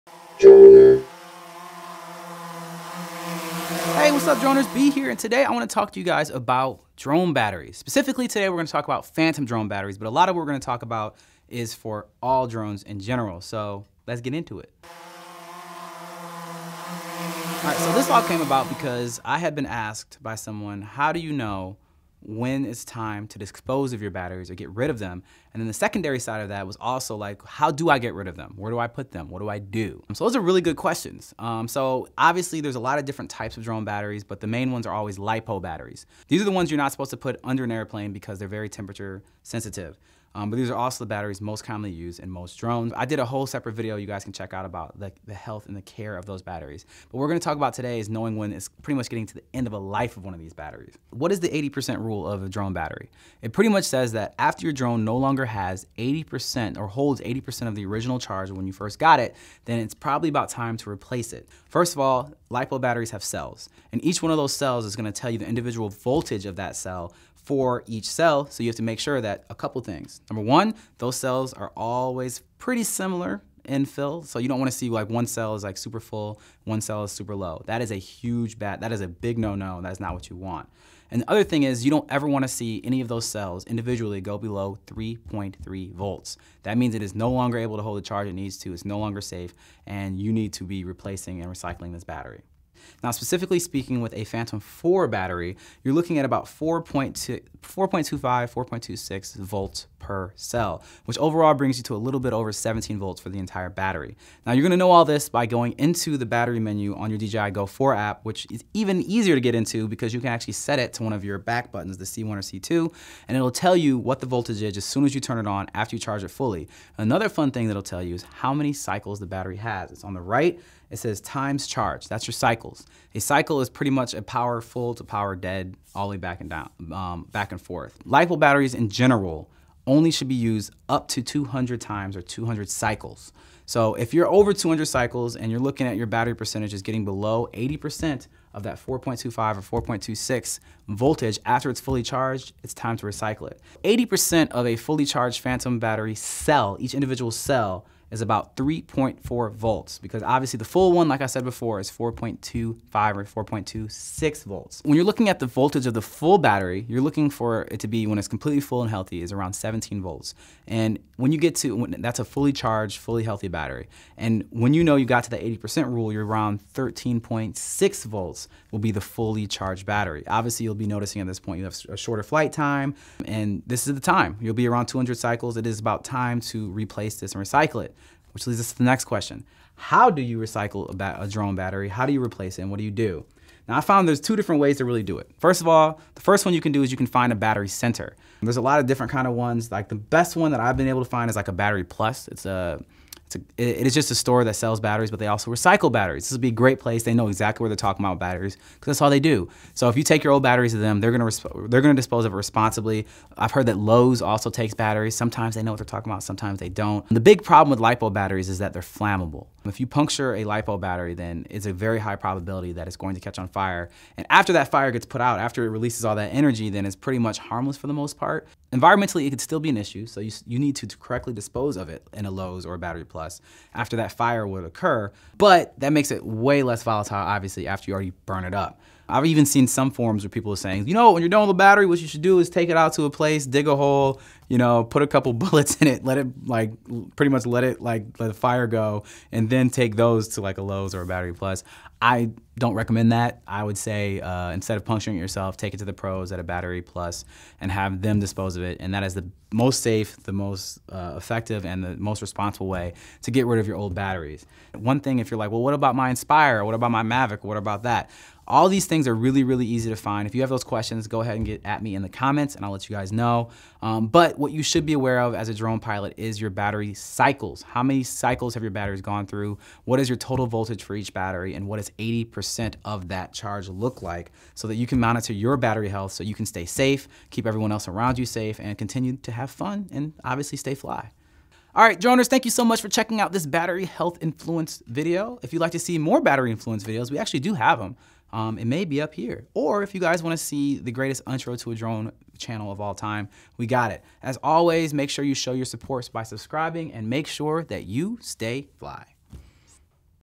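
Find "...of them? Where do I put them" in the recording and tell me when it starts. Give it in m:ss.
0:28.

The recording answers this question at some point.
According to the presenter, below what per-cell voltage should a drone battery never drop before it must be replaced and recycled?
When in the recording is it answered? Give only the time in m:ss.
1:24.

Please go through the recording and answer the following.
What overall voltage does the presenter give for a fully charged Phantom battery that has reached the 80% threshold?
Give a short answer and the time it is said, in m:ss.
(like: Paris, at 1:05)
13.6 volts, at 2:46.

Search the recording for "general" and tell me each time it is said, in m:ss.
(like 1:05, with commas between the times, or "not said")
0:12, 2:08.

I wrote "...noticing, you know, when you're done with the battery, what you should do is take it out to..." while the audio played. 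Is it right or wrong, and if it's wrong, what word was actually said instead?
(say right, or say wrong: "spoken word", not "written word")
wrong: "saying", not "noticing".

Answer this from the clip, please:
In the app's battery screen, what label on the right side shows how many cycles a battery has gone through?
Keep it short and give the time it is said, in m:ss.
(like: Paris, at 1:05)
times charge, at 2:01.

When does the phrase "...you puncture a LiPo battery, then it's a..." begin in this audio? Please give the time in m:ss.
3:29.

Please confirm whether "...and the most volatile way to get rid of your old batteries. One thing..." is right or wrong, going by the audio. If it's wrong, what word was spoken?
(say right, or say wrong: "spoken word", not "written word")
wrong: "responsible", not "volatile".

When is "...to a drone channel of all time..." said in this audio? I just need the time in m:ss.
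4:51.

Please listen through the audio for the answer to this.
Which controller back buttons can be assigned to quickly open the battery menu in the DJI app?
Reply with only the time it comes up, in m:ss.
1:51.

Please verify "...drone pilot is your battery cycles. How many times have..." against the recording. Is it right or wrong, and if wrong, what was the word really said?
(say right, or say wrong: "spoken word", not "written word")
wrong: "cycles", not "times".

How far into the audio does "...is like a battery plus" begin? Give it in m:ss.
3:11.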